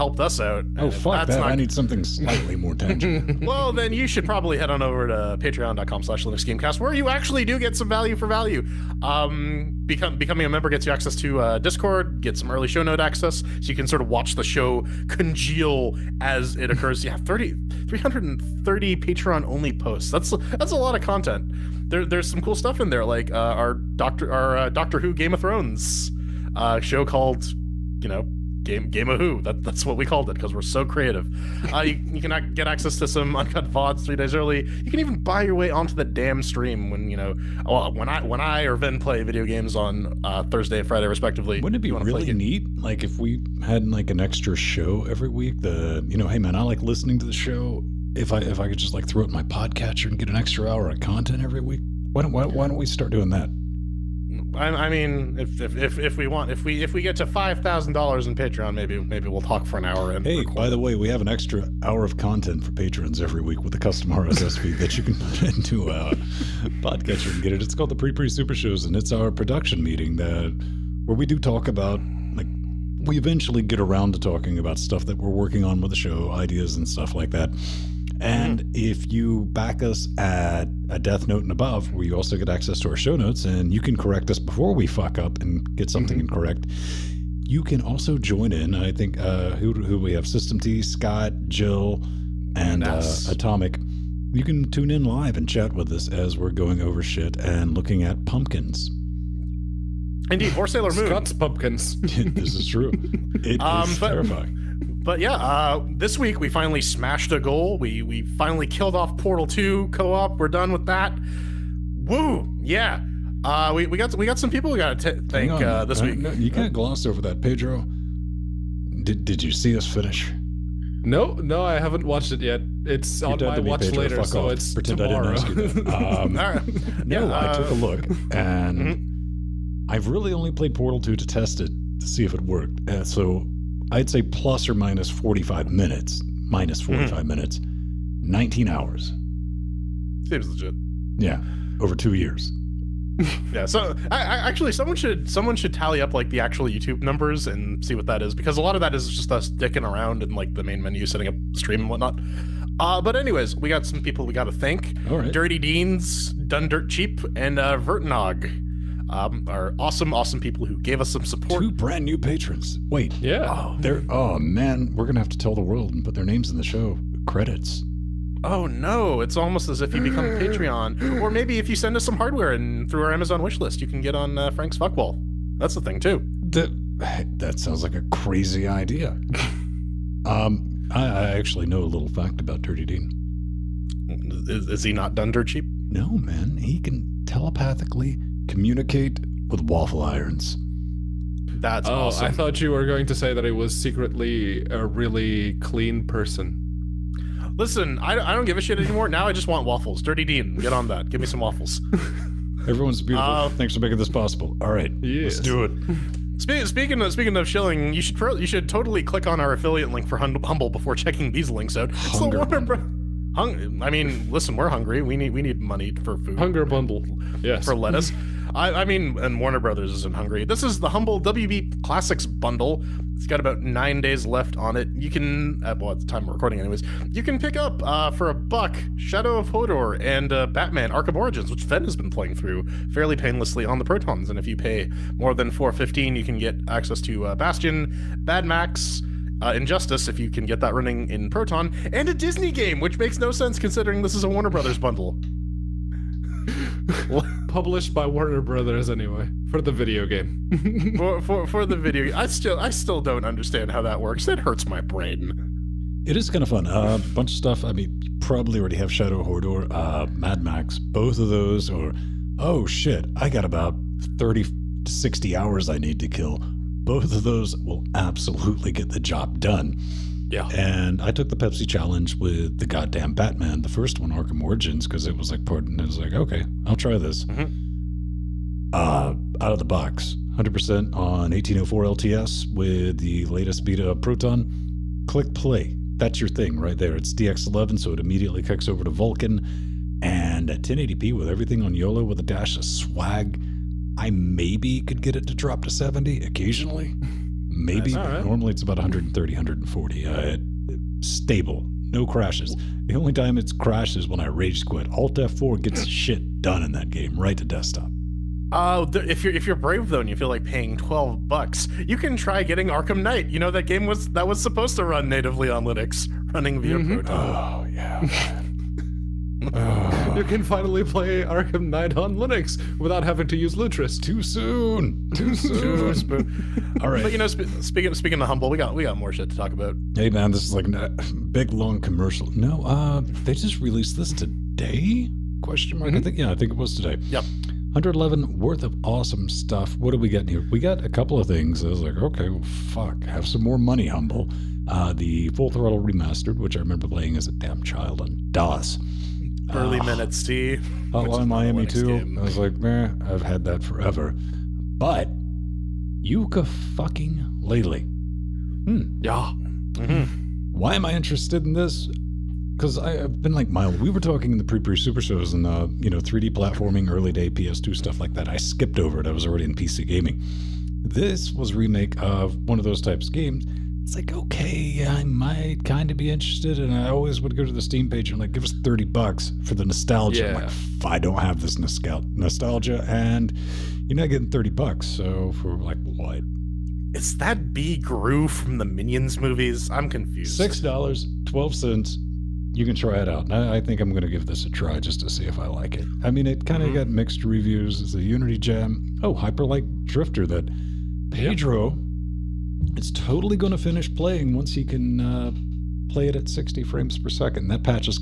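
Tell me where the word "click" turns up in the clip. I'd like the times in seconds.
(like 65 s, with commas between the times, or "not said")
209 s, 285 s.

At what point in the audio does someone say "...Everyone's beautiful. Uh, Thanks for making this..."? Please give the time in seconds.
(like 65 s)
202 s.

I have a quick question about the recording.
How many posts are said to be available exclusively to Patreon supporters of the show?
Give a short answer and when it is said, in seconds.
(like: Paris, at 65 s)
330, at 17 s.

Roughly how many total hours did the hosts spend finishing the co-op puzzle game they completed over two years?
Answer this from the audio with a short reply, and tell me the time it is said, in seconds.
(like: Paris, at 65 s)
19 hours, at 138 s.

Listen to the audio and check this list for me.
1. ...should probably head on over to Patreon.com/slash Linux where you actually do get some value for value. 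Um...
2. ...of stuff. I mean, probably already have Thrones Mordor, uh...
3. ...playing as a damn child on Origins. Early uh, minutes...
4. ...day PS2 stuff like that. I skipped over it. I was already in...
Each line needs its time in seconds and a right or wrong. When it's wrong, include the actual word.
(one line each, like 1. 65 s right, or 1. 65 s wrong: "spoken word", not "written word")
1. 4 s right
2. 257 s wrong: "Shadow", not "Thrones"
3. 346 s wrong: "DOS", not "Origins"
4. 367 s right.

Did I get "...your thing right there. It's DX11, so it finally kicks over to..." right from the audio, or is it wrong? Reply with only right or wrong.
wrong.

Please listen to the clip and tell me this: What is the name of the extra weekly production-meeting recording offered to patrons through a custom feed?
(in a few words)
Pre Pre Super Shows.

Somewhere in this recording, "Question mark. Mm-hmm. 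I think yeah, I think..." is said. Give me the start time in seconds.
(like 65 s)
335 s.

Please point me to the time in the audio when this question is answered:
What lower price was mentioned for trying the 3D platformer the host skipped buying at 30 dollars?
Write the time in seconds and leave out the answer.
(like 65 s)
390 s.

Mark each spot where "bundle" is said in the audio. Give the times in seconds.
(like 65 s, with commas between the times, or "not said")
216 s, 222 s, 244 s.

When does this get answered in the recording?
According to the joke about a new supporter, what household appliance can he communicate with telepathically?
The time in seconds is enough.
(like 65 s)
189 s.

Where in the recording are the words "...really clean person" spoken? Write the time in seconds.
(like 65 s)
194 s.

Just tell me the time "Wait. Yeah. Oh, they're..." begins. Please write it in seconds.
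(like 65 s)
162 s.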